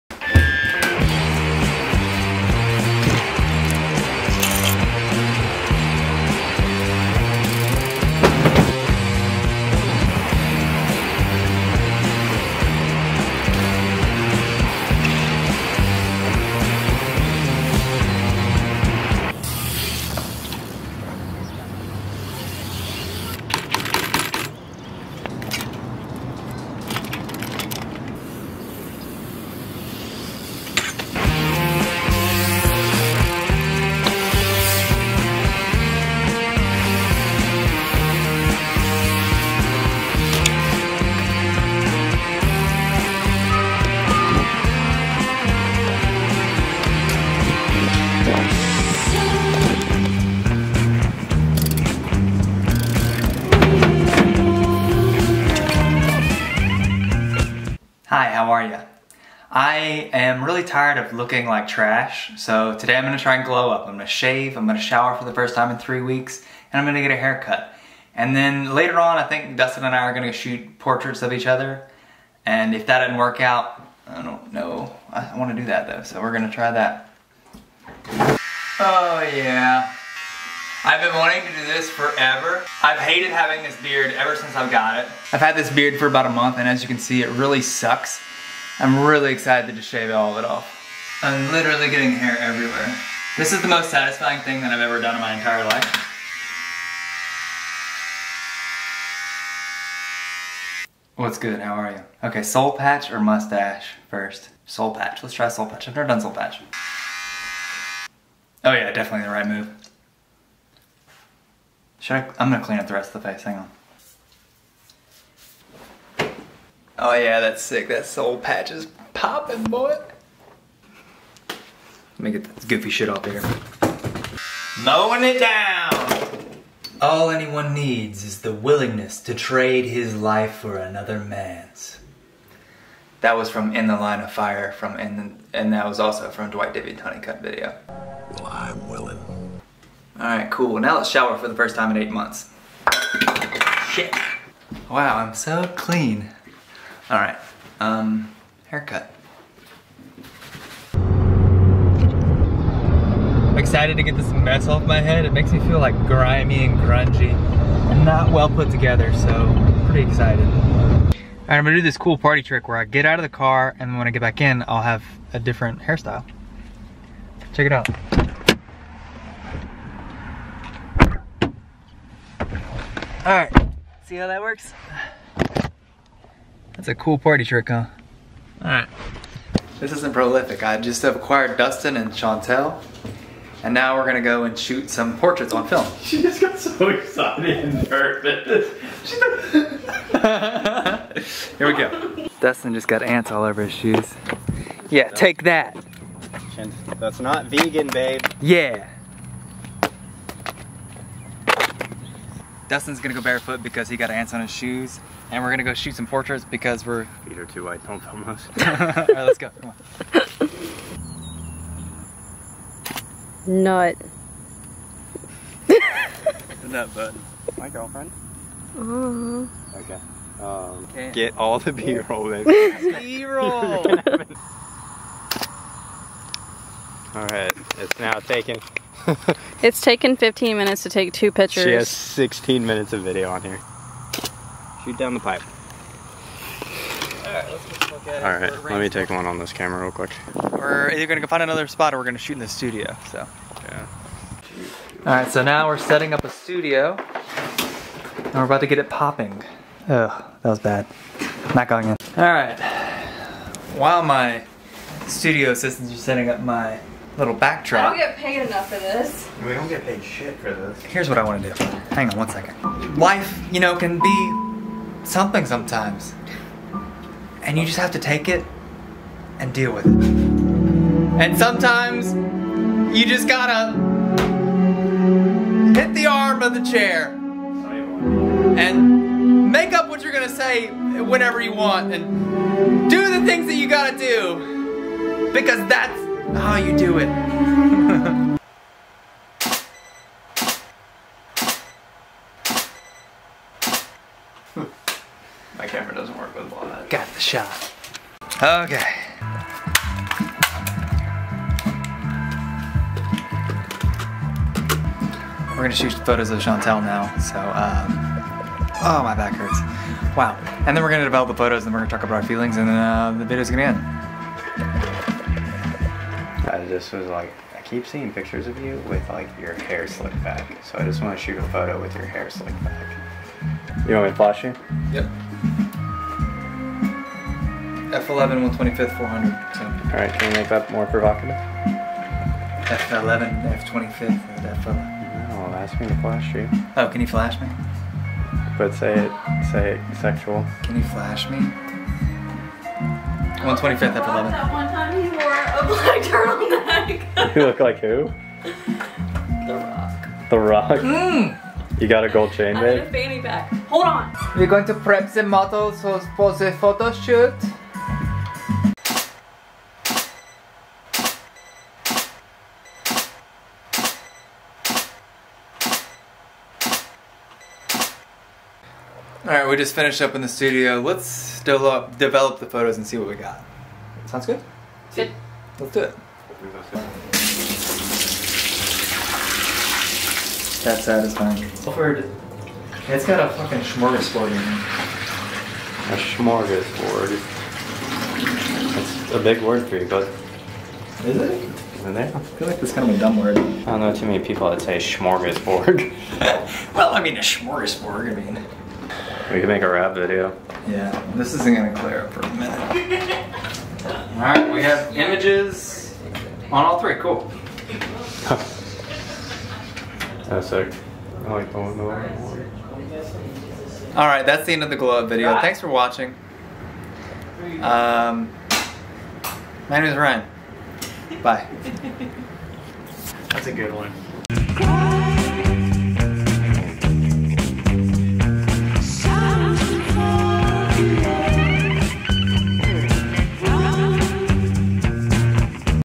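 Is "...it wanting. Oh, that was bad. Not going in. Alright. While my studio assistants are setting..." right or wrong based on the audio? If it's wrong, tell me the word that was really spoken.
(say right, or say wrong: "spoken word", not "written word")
wrong: "popping", not "wanting".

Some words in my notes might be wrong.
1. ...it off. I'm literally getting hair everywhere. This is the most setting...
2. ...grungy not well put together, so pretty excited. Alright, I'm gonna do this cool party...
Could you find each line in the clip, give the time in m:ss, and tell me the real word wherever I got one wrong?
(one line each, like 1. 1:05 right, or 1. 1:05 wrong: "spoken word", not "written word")
1. 1:30 wrong: "satisfying", not "setting"
2. 2:36 right.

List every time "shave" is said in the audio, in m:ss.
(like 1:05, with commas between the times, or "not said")
1:04, 1:29.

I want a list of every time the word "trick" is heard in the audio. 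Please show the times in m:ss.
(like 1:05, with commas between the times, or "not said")
2:42, 2:57.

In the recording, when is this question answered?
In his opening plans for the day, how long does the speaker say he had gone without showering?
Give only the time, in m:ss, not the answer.
1:05.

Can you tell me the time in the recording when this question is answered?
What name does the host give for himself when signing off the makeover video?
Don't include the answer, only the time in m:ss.
6:59.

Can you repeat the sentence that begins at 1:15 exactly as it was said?
I wanna do that though, so we're gonna try that.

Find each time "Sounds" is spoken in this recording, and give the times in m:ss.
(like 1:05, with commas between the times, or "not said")
6:14.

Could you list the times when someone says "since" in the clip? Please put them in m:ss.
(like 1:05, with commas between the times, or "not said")
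1:24.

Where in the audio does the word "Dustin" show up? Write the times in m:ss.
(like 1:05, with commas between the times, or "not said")
1:09, 3:01, 3:12, 3:22.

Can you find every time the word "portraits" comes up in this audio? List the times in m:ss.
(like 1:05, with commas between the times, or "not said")
1:10, 3:05, 3:26.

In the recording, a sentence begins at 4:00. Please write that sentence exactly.
We're either gonna go find another spot or we're gonna shoot in the studio, so.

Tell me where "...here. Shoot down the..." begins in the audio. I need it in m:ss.
3:53.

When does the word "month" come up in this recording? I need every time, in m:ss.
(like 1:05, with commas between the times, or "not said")
1:26, 2:22.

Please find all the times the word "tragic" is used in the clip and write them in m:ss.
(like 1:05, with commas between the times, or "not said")
not said.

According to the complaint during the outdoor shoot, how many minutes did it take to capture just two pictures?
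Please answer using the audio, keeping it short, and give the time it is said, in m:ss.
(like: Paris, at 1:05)
15, at 3:50.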